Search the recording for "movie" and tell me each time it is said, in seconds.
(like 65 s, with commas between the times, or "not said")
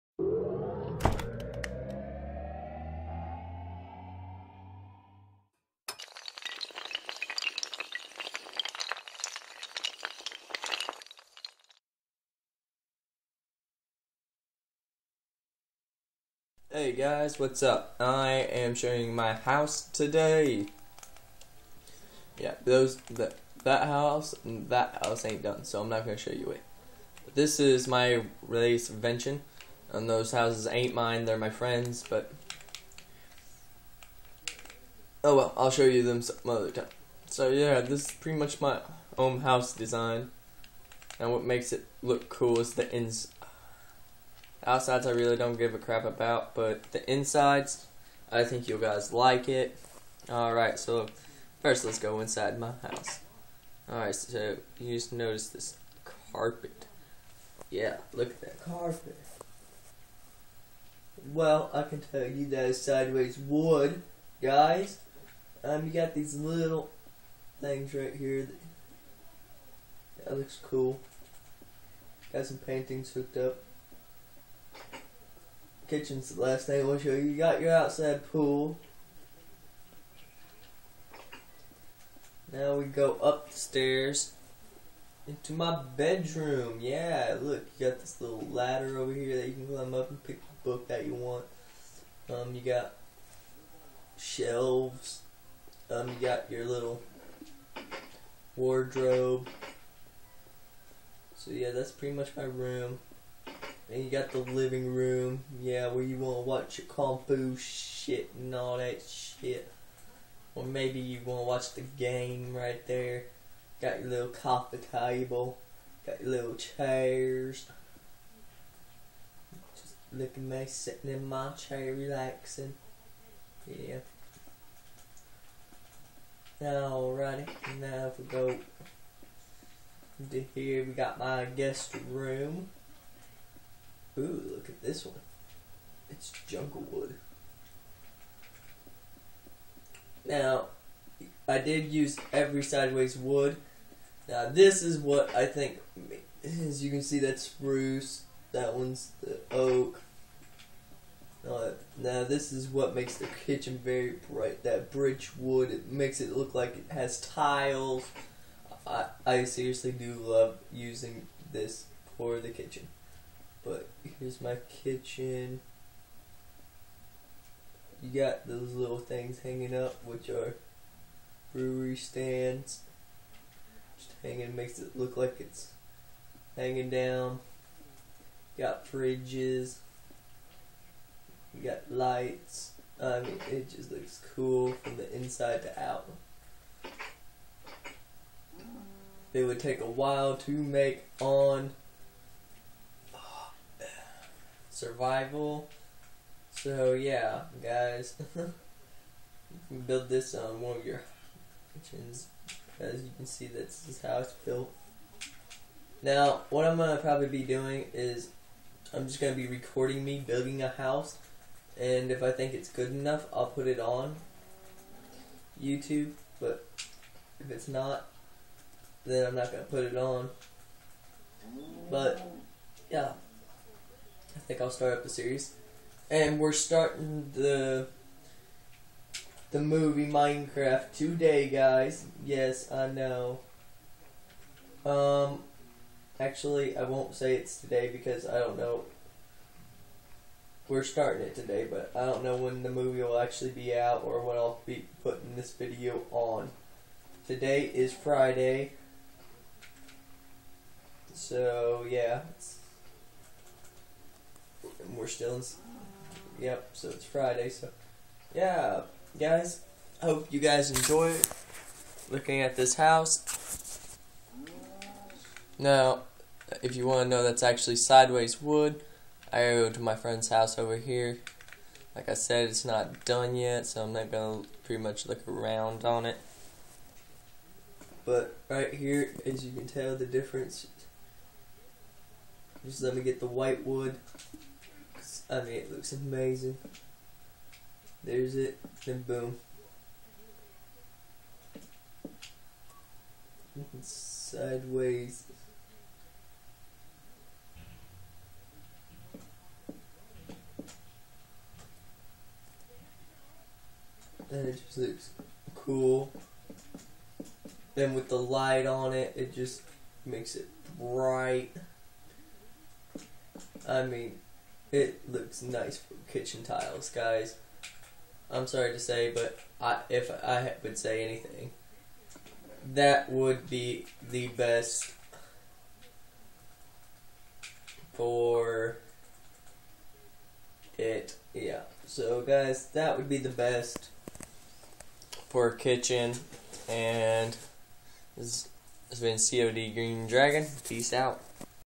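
229 s, 242 s.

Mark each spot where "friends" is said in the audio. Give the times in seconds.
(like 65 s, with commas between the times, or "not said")
31 s, 269 s.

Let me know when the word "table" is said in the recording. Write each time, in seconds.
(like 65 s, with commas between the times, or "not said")
114 s.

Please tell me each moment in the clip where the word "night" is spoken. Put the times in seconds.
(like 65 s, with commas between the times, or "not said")
76 s.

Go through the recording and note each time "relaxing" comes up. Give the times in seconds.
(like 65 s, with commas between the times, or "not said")
121 s.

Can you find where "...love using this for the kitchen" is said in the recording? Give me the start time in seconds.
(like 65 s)
160 s.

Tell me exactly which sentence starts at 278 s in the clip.
But right here, as you can tell, the difference.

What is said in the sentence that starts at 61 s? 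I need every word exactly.
Well, I can tell you that is sideways wood, guys.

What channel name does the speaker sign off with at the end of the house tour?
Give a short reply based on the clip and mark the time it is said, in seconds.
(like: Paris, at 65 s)
COD Green Dragon, at 339 s.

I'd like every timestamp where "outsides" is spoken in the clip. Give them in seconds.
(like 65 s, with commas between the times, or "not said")
44 s, 77 s.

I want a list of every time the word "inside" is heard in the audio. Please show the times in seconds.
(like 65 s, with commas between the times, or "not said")
47 s, 52 s, 185 s.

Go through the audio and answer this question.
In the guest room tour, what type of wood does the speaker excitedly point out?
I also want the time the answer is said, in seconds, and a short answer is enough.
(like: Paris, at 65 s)
Jungle wood, at 136 s.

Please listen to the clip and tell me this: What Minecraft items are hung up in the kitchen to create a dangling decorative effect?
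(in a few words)
Brewing stands.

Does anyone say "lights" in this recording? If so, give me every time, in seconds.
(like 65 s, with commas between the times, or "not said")
181 s, 308 s.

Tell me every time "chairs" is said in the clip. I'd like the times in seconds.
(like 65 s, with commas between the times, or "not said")
116 s, 121 s.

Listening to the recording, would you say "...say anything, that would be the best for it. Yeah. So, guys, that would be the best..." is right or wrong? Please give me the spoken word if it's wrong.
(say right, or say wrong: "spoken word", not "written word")
right.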